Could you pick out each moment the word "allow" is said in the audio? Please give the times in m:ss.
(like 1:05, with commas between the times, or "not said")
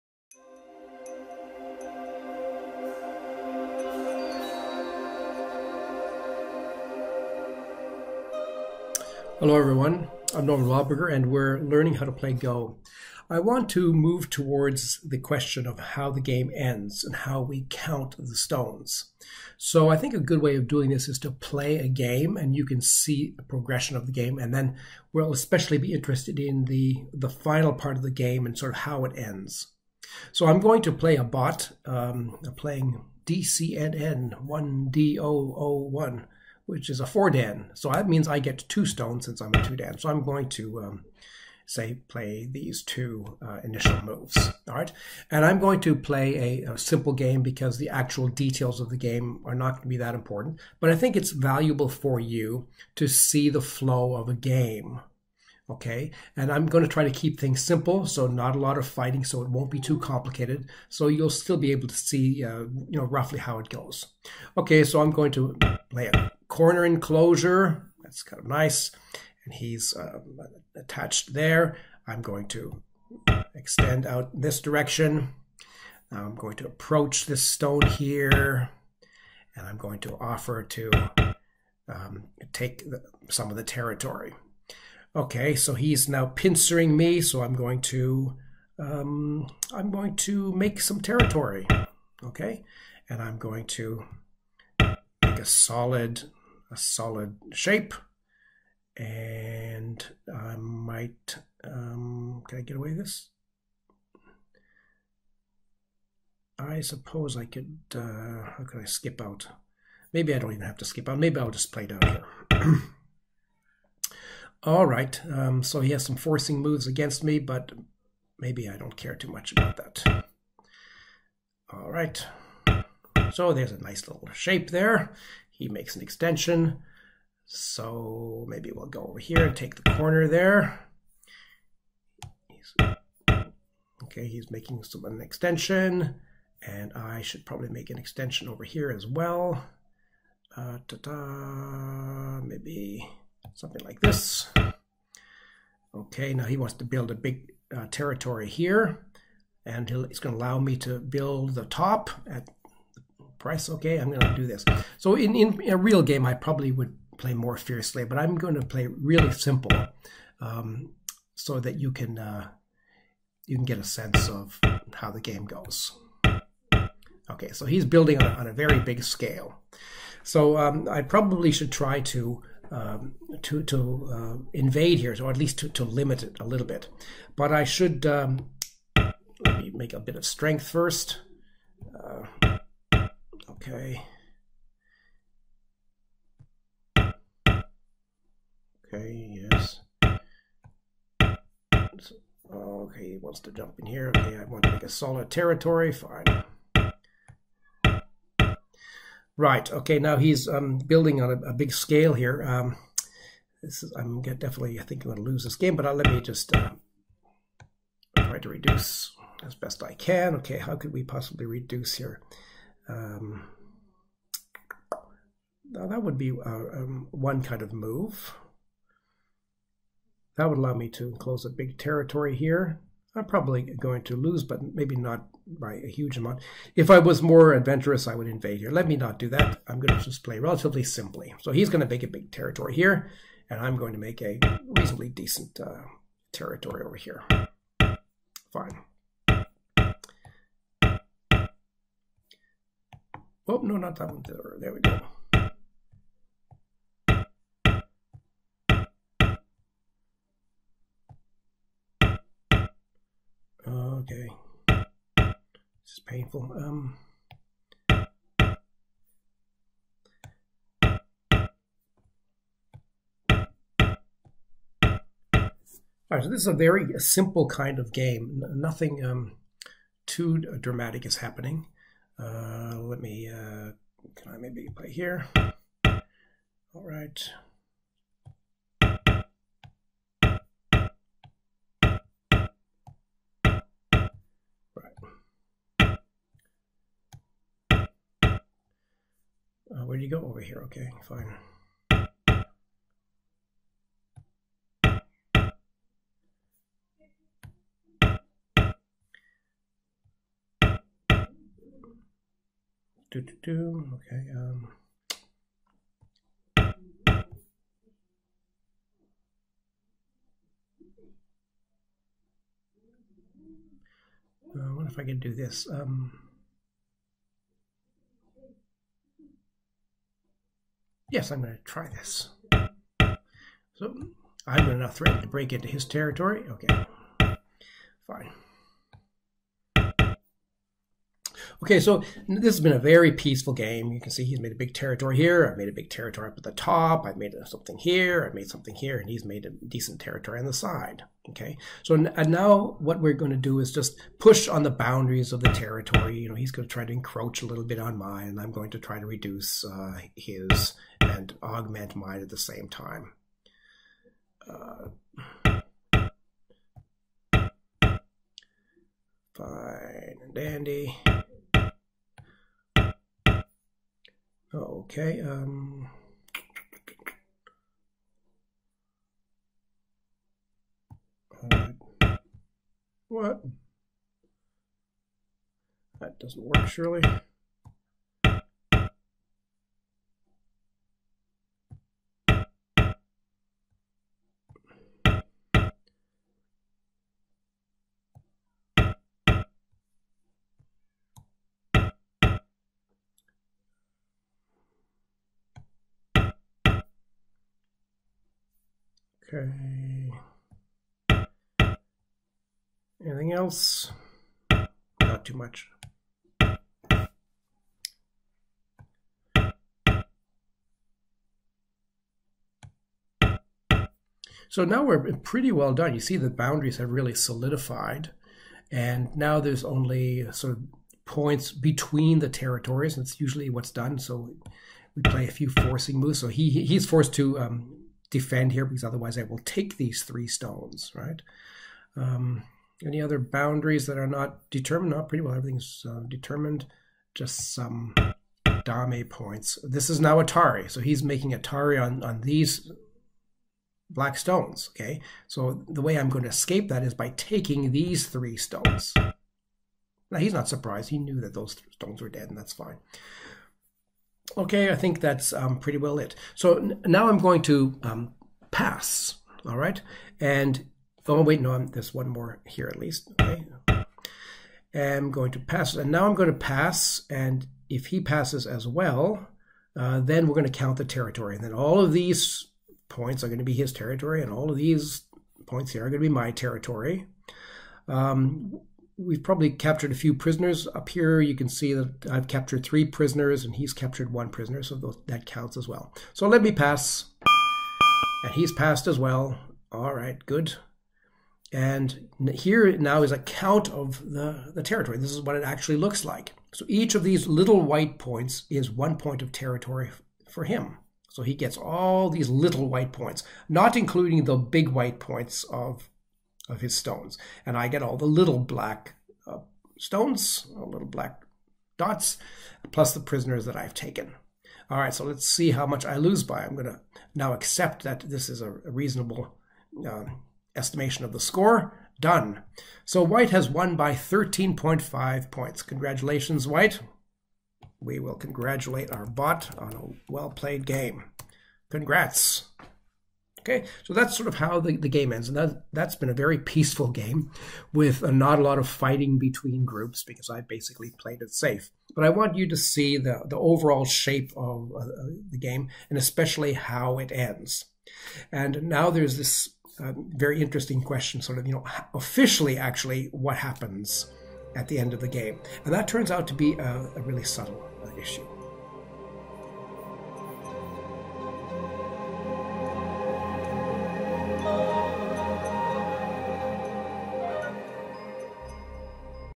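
2:30, 3:40.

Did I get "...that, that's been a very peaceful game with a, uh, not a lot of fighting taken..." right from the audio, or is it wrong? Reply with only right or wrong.
wrong.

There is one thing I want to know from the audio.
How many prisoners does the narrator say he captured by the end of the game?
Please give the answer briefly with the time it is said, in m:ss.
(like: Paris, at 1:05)
3, at 8:02.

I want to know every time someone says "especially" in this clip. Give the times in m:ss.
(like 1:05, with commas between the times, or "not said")
0:25, 9:05.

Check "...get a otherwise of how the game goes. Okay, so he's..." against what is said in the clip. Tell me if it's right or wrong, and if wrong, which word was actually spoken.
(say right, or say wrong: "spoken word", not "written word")
wrong: "sense", not "otherwise".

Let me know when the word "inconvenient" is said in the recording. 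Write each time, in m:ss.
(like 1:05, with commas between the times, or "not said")
not said.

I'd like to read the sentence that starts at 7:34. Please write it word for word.
Okay, I think that's um, pretty well it.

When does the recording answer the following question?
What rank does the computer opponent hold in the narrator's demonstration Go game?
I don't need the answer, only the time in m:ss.
0:37.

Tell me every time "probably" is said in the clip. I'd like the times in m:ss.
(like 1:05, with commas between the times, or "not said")
2:17, 2:36, 2:51, 3:43, 7:59.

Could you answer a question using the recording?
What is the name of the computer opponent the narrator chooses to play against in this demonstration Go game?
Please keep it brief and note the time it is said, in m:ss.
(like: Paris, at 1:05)
DCNN1D001, at 0:33.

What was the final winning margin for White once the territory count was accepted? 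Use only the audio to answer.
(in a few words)
13.5 points.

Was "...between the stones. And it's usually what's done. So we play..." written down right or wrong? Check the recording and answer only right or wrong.
wrong.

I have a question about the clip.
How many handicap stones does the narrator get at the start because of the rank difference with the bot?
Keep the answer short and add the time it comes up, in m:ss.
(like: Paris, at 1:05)
2, at 0:38.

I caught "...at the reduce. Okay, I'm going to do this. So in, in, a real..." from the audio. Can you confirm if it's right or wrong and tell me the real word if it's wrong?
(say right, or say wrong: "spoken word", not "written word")
wrong: "price", not "reduce".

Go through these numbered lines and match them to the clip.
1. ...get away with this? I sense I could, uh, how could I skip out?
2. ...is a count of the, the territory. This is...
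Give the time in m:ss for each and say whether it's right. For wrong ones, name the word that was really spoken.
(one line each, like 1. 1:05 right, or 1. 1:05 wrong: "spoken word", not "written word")
1. 1:42 wrong: "suppose", not "sense"
2. 8:13 right.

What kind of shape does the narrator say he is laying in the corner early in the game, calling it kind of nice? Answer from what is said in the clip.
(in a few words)
Corner enclosure.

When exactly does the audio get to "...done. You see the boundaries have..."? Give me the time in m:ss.
6:55.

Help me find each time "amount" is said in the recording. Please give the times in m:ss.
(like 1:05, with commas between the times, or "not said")
3:46.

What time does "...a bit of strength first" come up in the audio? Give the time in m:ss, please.
2:59.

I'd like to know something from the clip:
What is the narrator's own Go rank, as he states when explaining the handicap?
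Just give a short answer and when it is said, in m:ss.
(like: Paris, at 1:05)
2-dan, at 0:39.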